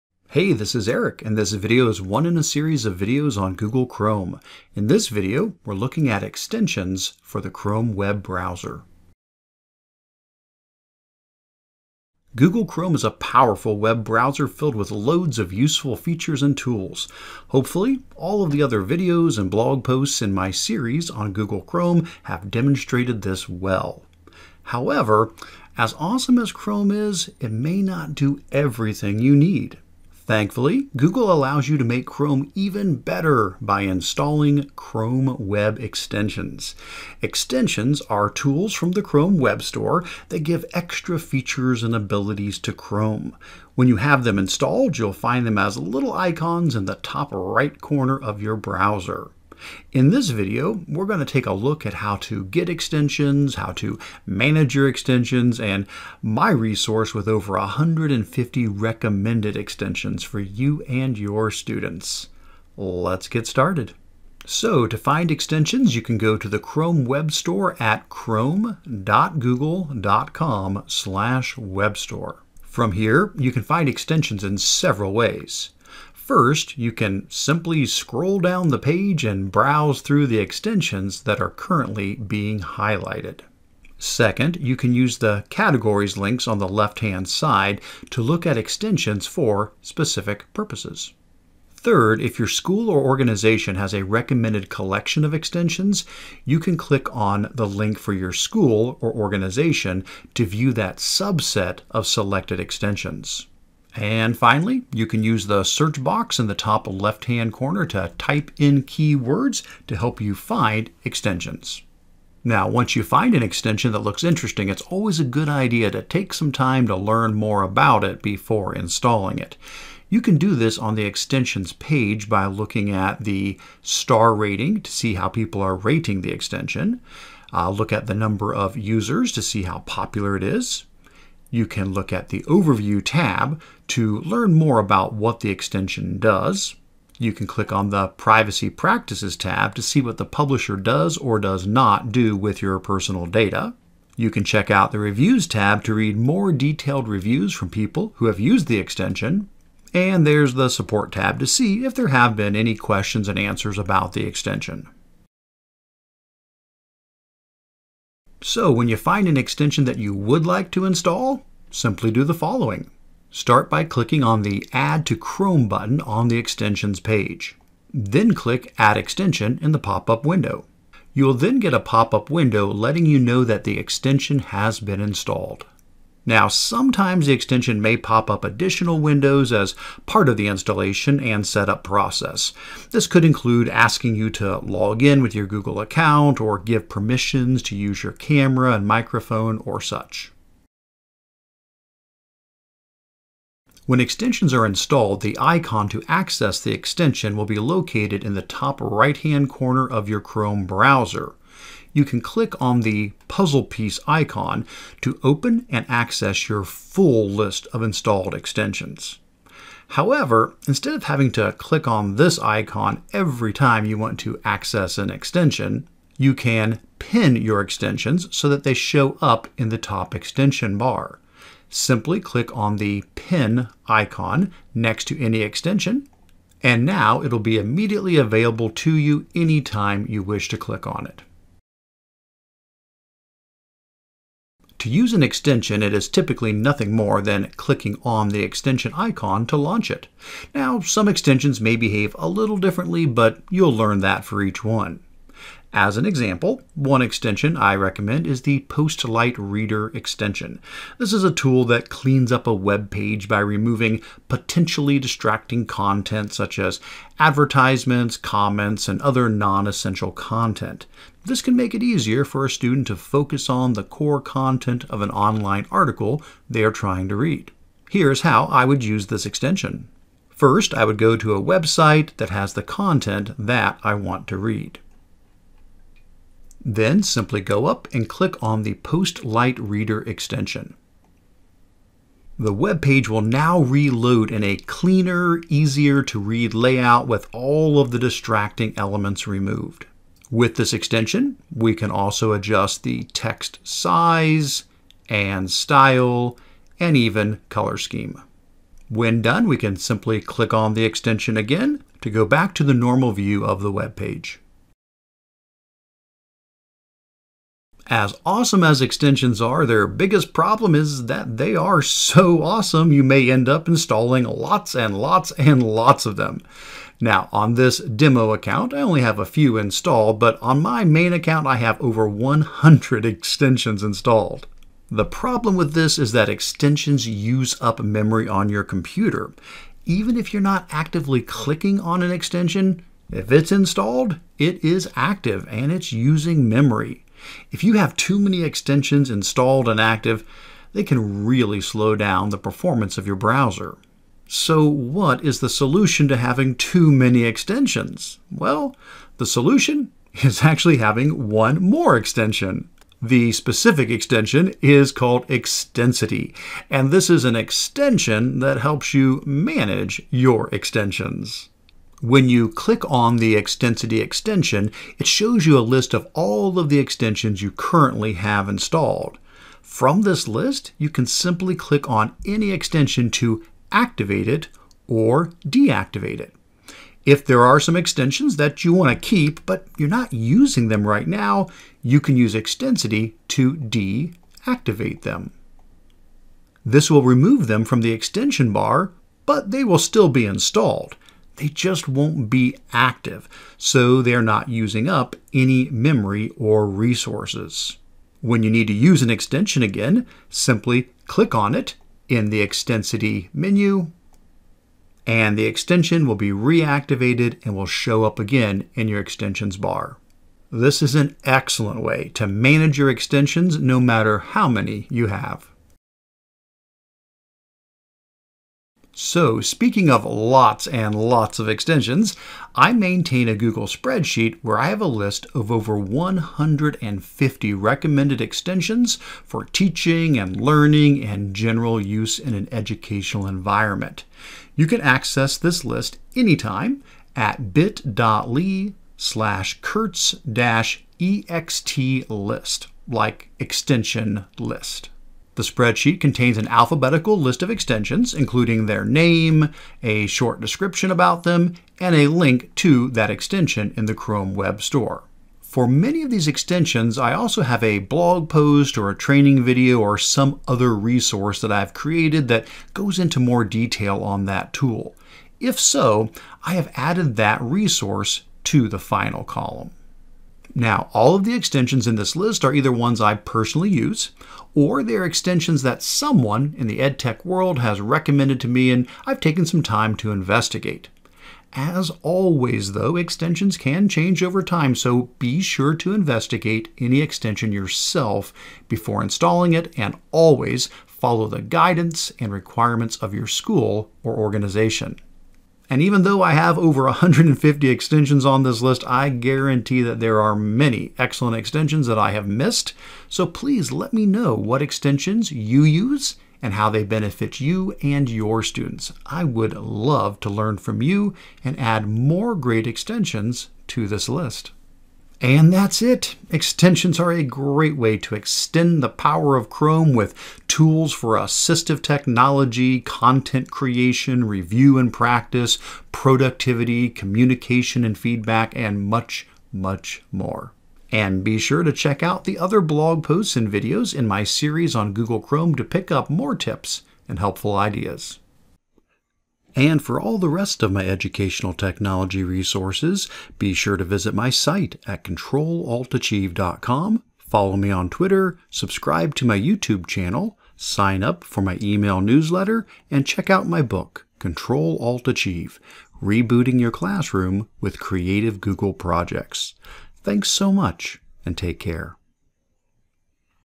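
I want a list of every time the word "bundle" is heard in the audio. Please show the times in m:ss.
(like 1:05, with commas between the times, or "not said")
not said.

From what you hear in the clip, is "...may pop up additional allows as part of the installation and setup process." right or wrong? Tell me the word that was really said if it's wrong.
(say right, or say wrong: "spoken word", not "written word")
wrong: "windows", not "allows".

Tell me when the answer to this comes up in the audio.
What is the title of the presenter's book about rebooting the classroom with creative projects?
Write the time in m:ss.
9:14.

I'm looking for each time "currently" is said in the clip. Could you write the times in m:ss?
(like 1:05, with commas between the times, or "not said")
1:21, 6:07.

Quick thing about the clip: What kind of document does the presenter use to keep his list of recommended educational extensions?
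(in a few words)
Google spreadsheet.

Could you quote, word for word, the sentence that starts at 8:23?
So please let me know what extensions you use and how they benefit you and your students.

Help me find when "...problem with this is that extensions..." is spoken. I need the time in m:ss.
5:25.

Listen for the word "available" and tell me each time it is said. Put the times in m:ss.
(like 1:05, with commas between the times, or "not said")
3:48.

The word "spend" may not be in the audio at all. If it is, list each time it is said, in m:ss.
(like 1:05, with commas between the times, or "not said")
not said.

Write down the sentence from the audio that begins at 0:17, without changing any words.
Hopefully, all of the other videos and blog posts in my series on Google Chrome have demonstrated this well.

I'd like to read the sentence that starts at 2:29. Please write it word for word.
And there's the Support tab to see if there have been any questions and answers about the extension.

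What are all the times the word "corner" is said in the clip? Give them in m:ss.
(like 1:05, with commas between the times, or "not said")
0:47, 1:47, 3:19.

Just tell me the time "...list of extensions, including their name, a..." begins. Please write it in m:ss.
7:27.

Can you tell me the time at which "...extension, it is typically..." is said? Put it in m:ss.
3:55.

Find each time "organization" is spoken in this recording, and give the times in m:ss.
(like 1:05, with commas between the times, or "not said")
1:33, 1:39, 8:14.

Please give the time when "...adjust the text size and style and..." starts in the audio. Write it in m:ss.
4:52.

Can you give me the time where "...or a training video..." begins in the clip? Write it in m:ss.
7:38.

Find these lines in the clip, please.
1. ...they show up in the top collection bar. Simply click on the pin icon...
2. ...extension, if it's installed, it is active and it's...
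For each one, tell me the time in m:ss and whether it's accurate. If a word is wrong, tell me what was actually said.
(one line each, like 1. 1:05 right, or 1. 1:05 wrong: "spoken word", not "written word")
1. 3:38 wrong: "extension", not "collection"
2. 5:32 right.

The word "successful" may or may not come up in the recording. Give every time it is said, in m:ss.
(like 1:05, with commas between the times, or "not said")
not said.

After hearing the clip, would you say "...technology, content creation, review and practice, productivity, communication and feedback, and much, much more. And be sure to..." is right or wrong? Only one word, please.
right.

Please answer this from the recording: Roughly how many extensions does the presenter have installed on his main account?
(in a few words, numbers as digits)
over 100.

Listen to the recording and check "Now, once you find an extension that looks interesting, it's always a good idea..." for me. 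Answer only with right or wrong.
right.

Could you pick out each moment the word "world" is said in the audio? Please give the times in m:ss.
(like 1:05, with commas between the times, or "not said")
7:57.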